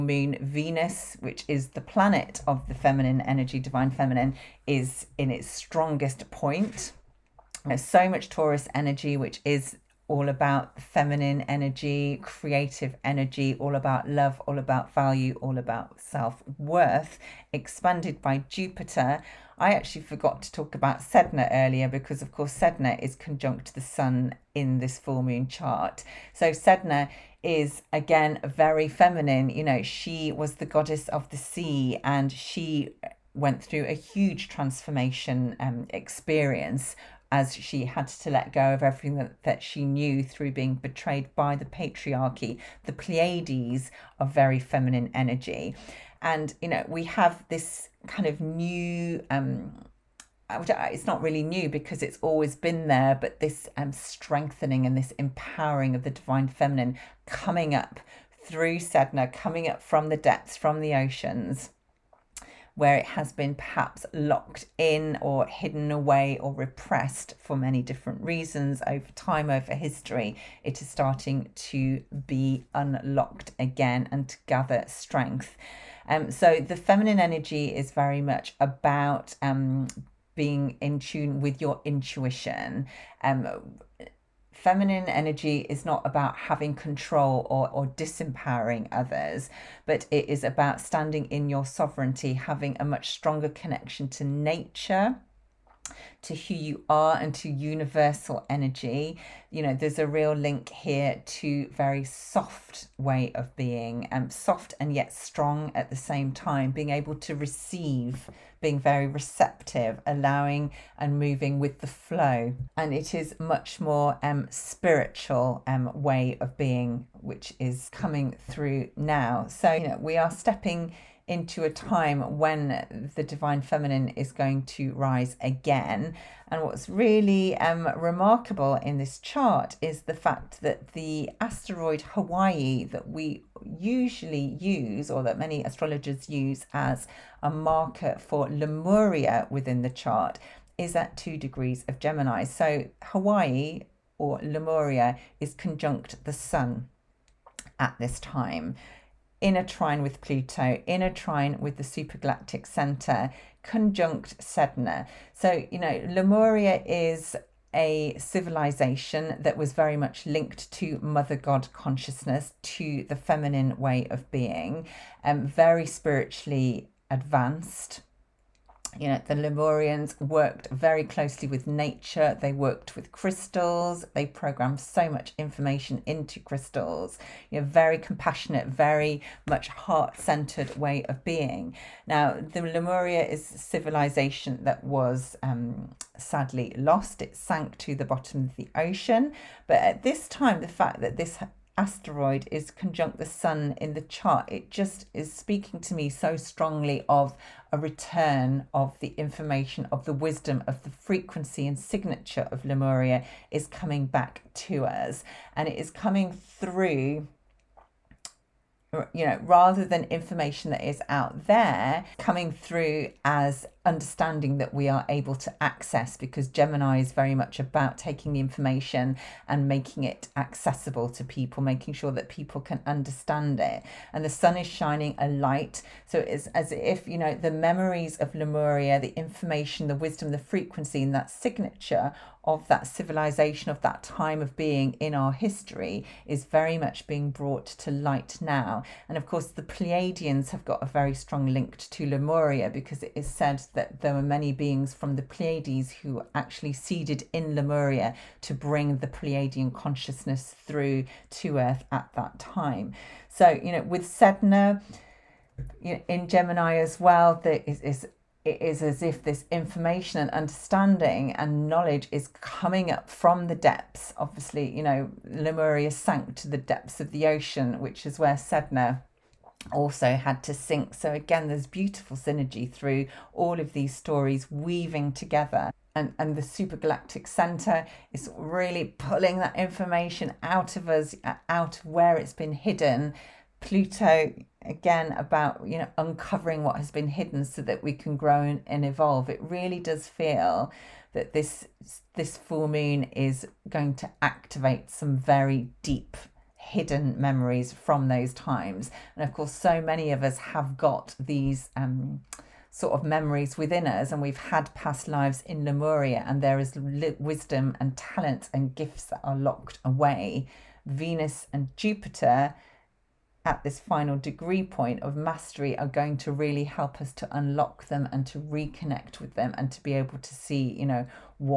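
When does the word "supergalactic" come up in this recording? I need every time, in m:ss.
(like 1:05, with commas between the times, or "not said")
2:31, 4:36.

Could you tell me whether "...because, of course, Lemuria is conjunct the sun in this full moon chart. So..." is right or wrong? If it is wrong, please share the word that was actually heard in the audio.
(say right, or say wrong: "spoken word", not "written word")
wrong: "Sedna", not "Lemuria".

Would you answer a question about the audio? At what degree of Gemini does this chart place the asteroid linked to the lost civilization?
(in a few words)
2.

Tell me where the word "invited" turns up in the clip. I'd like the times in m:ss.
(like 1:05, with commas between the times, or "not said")
not said.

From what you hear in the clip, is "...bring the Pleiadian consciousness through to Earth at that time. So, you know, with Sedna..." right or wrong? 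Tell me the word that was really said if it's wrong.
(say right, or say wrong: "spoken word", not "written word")
right.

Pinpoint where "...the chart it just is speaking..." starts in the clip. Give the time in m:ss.
3:13.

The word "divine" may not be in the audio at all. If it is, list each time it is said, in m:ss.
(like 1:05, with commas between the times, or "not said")
0:03, 0:56, 2:03.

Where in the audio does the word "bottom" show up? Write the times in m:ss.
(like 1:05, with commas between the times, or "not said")
3:08.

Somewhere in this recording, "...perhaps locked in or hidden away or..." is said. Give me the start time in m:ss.
1:03.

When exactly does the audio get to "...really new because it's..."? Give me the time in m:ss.
0:51.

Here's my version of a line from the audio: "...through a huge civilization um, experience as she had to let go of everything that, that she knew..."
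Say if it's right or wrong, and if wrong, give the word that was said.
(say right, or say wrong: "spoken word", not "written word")
wrong: "transformation", not "civilization".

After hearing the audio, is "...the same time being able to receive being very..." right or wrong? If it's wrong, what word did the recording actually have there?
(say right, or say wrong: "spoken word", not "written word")
right.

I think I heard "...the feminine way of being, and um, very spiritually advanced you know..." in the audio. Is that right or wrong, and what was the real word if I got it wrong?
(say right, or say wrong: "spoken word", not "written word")
right.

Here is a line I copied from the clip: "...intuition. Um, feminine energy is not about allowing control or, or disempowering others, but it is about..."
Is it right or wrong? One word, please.
wrong.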